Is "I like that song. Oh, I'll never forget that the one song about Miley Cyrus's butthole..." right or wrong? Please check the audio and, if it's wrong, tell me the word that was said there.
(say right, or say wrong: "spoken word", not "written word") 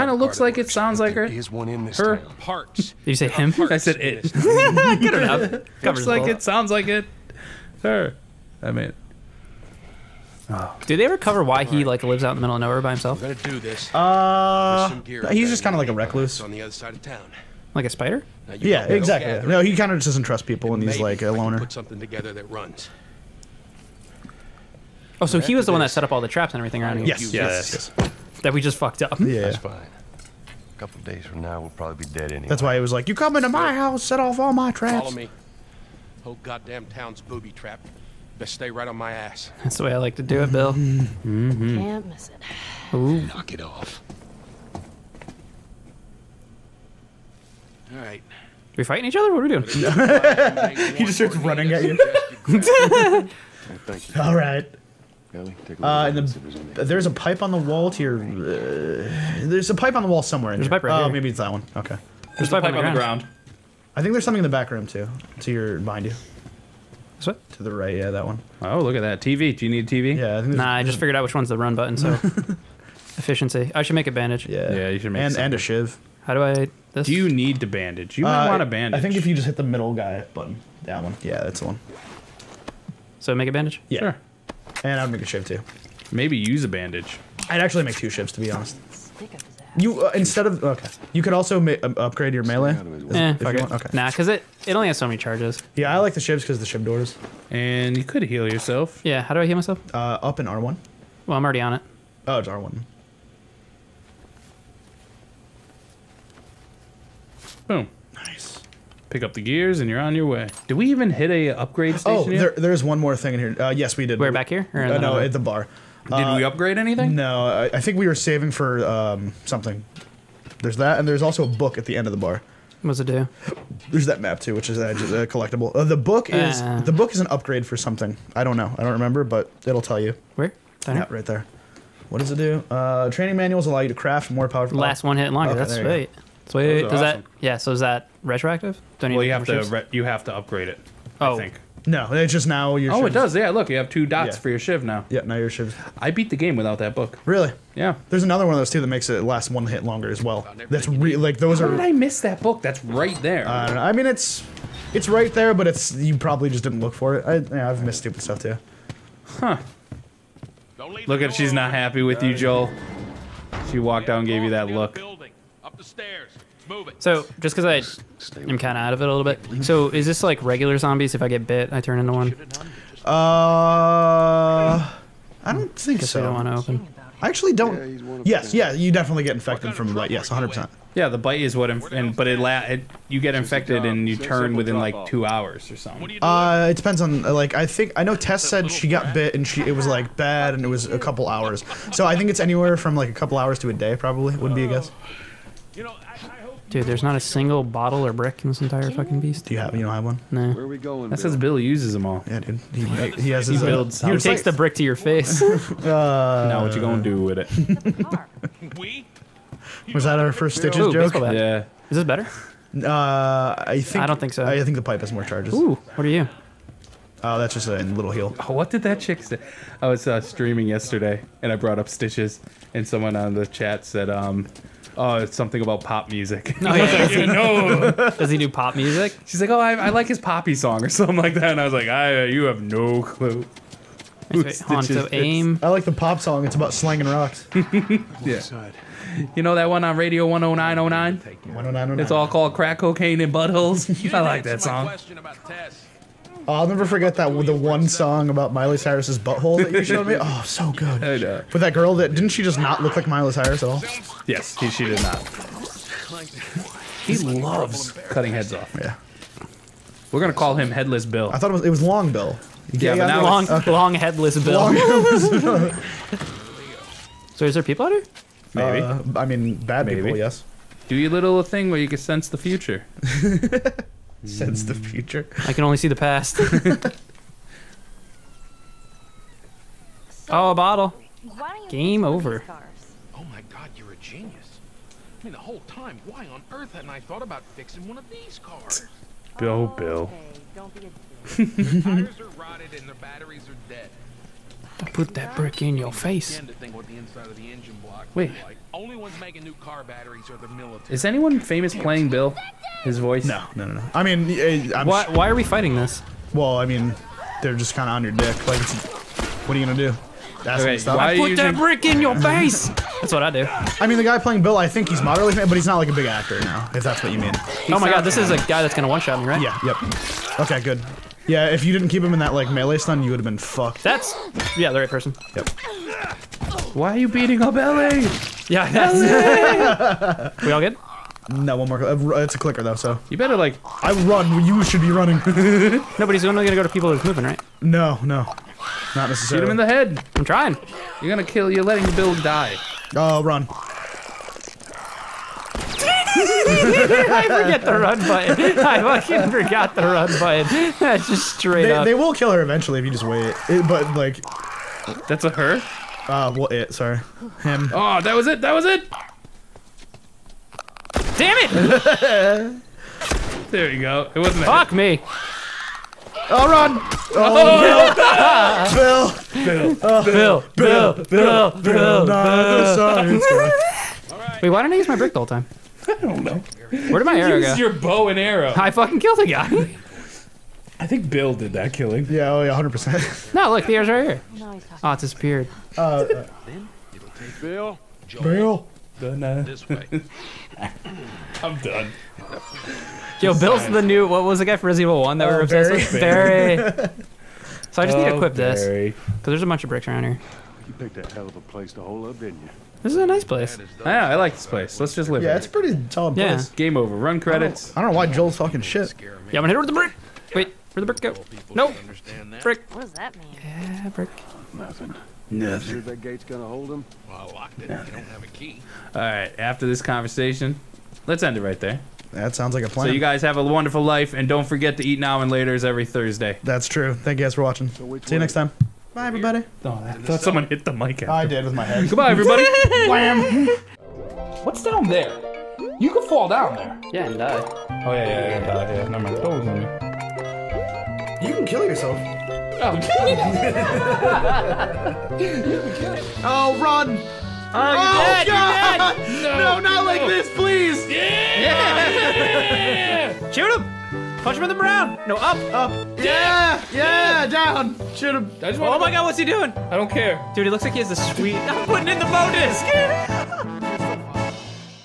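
right.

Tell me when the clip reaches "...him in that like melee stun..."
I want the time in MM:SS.
05:22.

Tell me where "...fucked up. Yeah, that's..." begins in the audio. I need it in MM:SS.
00:28.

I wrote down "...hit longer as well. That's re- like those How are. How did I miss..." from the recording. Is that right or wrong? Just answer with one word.
right.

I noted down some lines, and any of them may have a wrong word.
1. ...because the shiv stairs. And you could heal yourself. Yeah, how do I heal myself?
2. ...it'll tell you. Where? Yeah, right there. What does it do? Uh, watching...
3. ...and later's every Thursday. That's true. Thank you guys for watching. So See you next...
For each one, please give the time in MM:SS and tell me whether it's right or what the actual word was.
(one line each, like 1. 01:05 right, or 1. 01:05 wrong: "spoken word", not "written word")
1. 01:36 wrong: "doors", not "stairs"
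2. 02:09 wrong: "training", not "watching"
3. 07:05 right.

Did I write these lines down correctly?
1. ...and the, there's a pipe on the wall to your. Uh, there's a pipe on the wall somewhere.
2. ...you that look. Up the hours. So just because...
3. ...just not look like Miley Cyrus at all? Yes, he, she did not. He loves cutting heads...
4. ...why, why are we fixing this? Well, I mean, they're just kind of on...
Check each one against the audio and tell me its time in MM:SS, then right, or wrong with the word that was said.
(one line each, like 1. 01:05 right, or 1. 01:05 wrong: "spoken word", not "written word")
1. 00:56 right
2. 02:44 wrong: "stairs", not "hours"
3. 04:12 right
4. 05:04 wrong: "fighting", not "fixing".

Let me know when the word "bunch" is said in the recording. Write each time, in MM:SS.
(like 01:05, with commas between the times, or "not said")
06:39.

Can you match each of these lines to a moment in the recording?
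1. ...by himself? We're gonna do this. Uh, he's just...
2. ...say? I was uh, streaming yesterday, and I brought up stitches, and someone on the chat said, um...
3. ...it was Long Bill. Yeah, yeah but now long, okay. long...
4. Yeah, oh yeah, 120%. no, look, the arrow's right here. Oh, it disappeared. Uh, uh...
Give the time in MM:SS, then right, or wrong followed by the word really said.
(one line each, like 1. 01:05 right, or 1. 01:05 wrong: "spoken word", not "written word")
1. 00:12 right
2. 03:39 right
3. 04:21 right
4. 06:22 wrong: "100", not "120".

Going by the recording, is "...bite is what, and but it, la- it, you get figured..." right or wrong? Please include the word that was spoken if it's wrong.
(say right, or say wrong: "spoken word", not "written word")
wrong: "infected", not "figured".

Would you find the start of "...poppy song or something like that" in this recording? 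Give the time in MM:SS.
03:50.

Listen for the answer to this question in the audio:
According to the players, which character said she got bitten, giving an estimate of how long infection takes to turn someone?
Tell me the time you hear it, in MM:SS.
03:08.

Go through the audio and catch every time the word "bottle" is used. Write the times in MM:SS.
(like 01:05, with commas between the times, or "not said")
03:17, 04:40.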